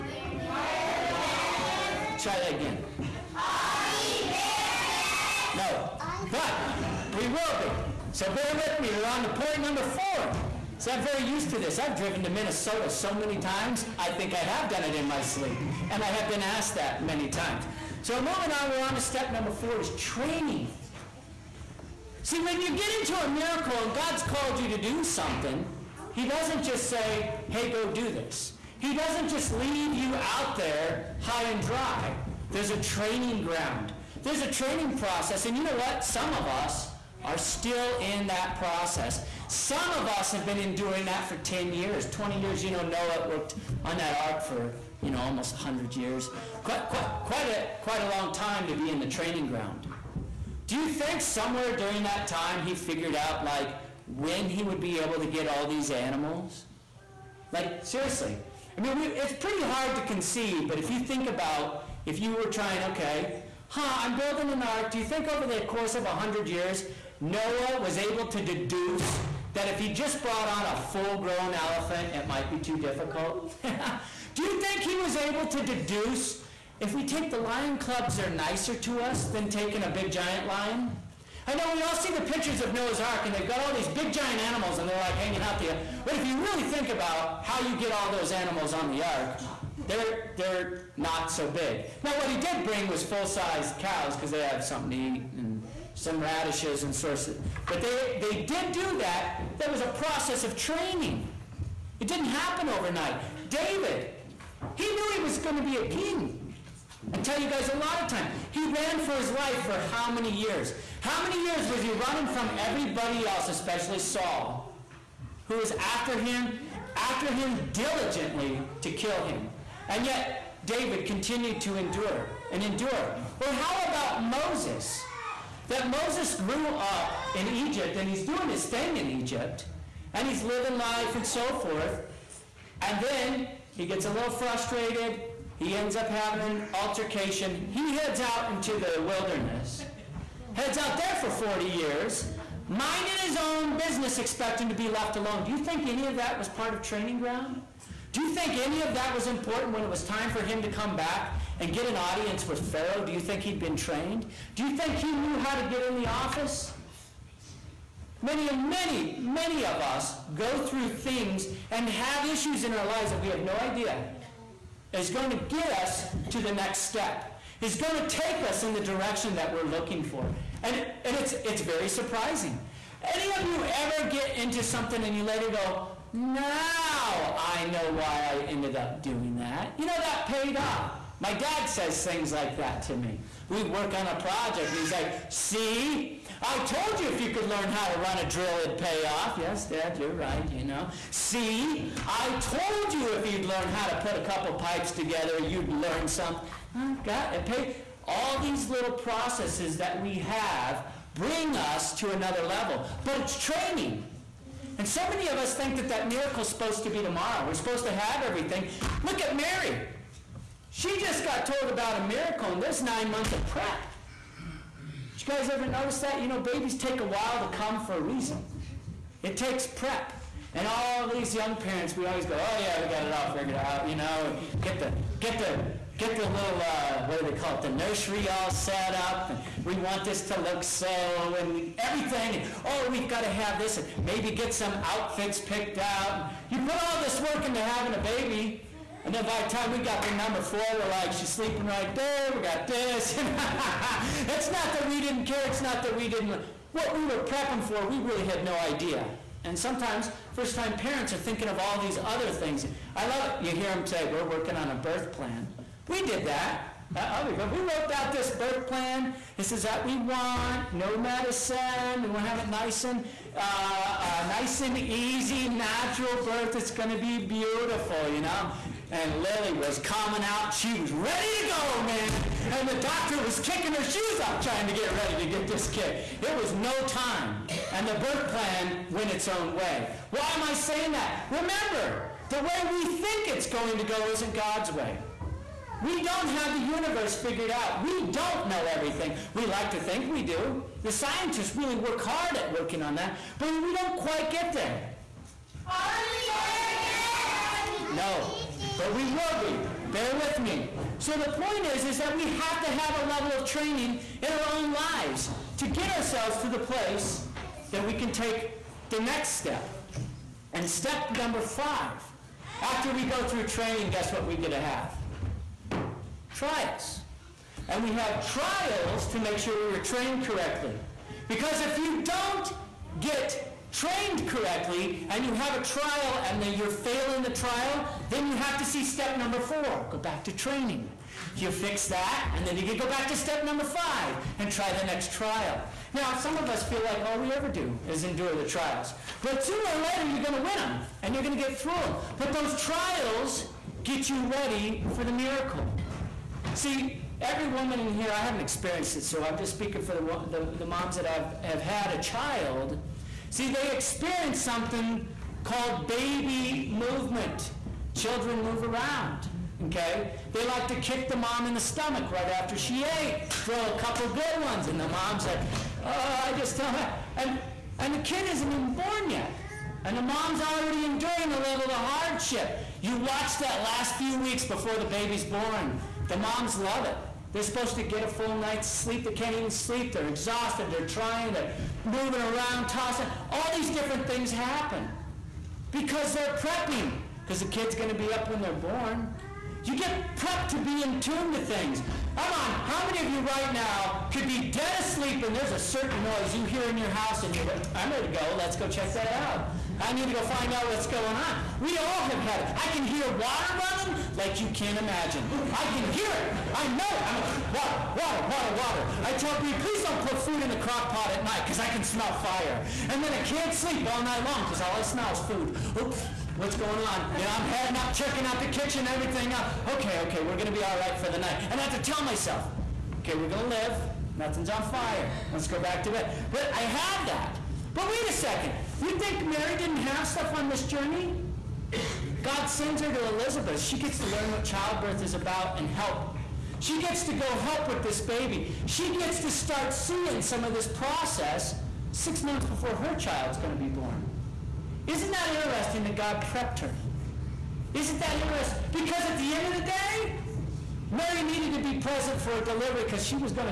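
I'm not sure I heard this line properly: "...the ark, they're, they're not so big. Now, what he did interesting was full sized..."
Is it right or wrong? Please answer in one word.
wrong.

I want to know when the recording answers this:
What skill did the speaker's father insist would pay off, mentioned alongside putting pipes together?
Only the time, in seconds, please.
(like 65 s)
187 s.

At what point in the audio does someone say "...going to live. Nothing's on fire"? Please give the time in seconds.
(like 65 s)
423 s.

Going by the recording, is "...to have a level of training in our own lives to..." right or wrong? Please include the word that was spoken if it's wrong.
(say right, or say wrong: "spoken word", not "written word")
right.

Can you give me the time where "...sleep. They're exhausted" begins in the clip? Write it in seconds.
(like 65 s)
379 s.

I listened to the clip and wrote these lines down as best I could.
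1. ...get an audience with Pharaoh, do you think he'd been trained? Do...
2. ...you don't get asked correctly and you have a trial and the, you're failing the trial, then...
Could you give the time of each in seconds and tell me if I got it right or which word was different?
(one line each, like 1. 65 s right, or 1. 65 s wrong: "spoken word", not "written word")
1. 151 s right
2. 321 s wrong: "trained", not "asked".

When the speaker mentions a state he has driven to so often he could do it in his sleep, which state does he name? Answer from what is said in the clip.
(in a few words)
Minnesota.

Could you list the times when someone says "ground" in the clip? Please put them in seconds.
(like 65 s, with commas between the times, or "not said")
33 s, 49 s, 147 s.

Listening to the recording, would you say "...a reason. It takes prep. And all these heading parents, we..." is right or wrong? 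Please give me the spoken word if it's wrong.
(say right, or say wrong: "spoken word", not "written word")
wrong: "young", not "heading".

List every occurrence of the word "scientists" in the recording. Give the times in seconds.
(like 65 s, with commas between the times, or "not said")
290 s.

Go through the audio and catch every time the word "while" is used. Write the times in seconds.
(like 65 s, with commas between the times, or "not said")
217 s.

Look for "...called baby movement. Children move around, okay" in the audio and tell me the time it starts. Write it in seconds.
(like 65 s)
355 s.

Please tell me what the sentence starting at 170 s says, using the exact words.
And, and it's, it's very surprising.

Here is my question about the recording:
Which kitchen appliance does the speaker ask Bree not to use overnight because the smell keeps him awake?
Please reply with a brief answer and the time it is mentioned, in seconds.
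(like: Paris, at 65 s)
crock pot, at 410 s.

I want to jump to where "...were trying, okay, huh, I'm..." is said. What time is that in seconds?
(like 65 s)
62 s.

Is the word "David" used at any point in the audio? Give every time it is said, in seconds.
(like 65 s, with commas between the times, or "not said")
103 s, 120 s.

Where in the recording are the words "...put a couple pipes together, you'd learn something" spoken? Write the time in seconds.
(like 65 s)
193 s.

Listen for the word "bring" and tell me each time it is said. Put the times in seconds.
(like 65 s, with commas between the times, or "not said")
92 s, 201 s.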